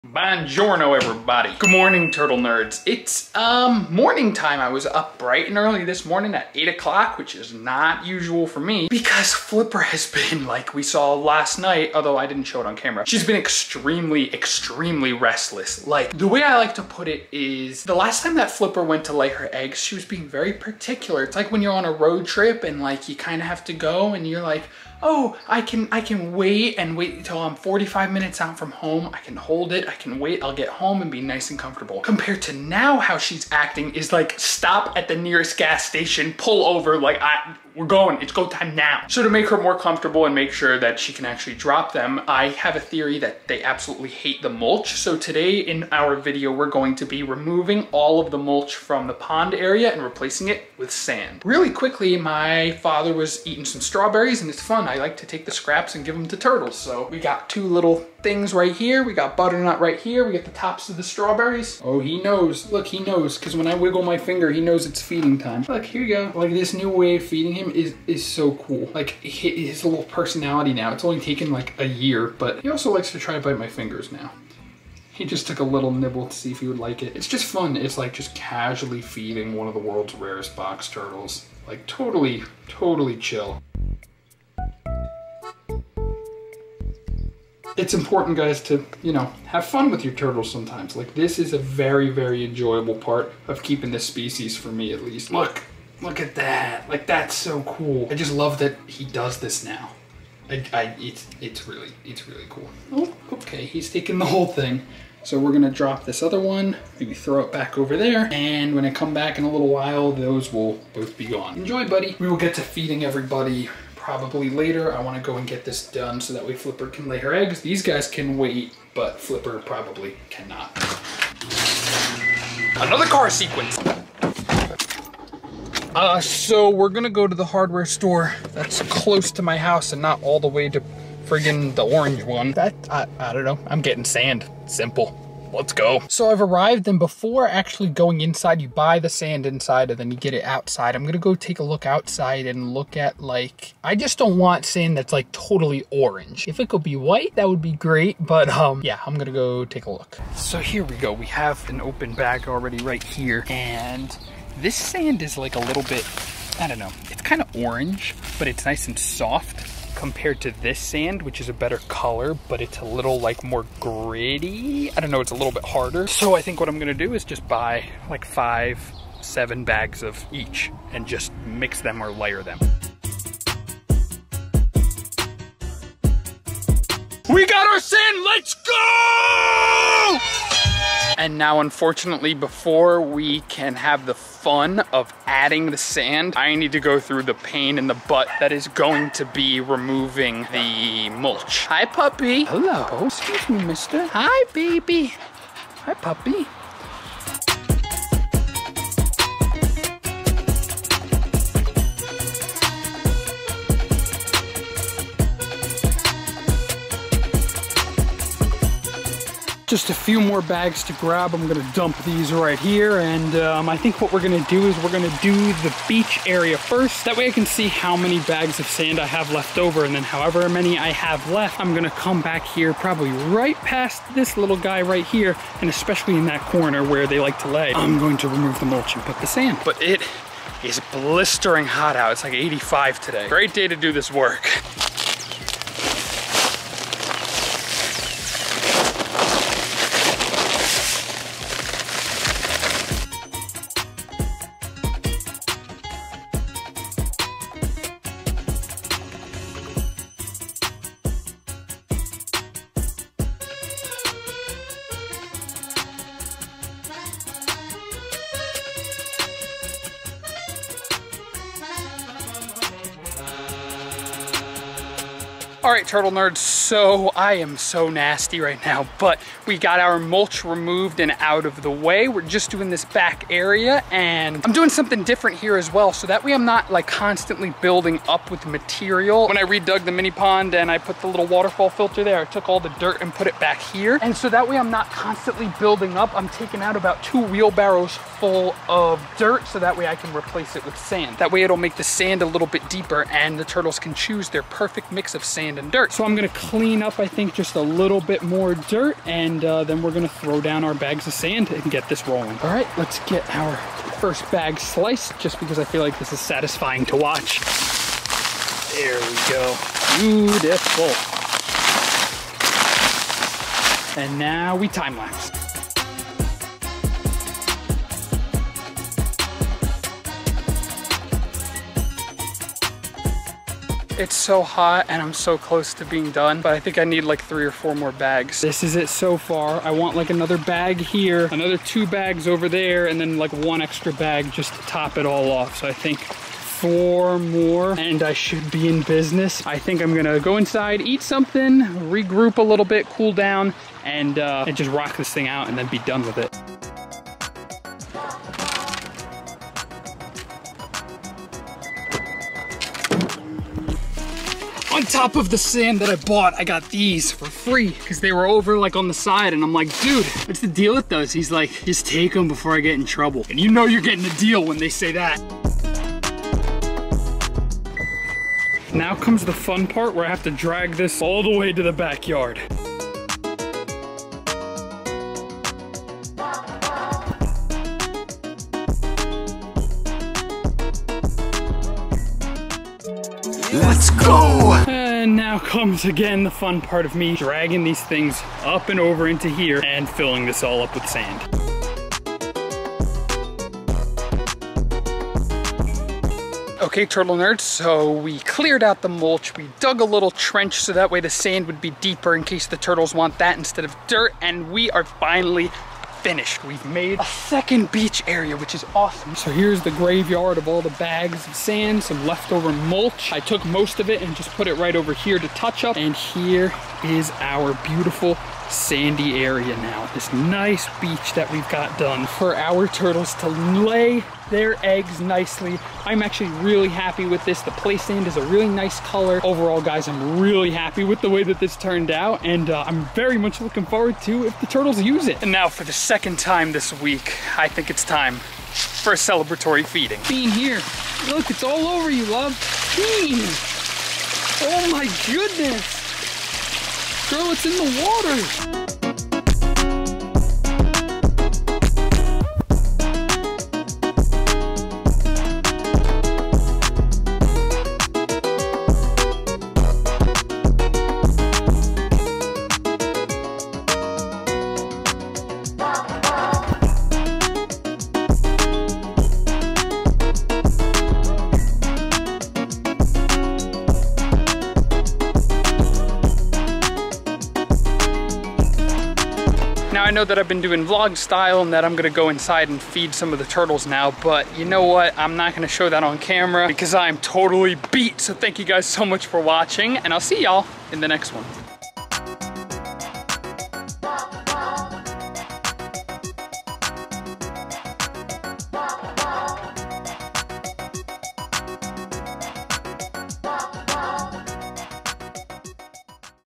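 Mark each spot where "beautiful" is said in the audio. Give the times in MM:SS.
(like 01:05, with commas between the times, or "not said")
05:09, 06:57.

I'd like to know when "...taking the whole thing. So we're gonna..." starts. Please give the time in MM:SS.
01:43.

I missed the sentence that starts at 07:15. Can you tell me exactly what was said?
And now for the second time this week, I think it's time for a celebratory feeding.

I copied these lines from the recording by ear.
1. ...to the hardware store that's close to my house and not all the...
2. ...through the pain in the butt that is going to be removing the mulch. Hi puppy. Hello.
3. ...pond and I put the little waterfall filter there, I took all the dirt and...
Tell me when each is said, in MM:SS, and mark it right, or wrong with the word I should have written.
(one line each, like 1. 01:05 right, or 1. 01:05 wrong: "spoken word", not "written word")
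1. 02:07 right
2. 03:06 right
3. 04:40 right.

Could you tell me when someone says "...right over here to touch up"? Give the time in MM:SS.
06:54.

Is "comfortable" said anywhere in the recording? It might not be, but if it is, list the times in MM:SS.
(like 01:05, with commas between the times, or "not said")
00:31, 00:39.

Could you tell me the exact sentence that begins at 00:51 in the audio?
Really quickly, my father was eating some strawberries and it's fun.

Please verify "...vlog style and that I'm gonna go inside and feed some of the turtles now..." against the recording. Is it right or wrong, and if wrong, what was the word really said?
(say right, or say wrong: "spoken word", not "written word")
right.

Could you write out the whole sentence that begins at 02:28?
But um, yeah, I'm gonna go take a look.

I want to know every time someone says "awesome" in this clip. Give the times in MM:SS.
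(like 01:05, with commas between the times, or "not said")
06:48.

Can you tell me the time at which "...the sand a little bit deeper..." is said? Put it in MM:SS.
04:51.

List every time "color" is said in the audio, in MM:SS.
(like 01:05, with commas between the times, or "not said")
02:41, 07:08.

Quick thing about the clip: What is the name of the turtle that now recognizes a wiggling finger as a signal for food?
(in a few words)
Butternut.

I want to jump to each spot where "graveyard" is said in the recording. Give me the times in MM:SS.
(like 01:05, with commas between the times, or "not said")
06:49.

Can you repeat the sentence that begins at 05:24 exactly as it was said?
It's so hot and I'm so close to being done, but I think I need like three or four more bags.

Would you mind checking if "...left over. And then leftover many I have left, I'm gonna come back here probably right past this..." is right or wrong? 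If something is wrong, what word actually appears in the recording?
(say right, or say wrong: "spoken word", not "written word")
wrong: "however", not "leftover".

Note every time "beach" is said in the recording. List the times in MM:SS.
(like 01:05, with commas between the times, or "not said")
03:35, 06:47, 07:00.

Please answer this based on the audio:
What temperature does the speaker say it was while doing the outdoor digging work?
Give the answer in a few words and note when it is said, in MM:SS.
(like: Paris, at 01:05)
85, at 03:52.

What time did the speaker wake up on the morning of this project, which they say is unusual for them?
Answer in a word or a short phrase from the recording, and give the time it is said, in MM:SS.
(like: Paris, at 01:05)
8 o'clock, at 00:06.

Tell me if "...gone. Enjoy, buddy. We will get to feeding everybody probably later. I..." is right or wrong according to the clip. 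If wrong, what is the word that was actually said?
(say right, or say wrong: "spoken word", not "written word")
right.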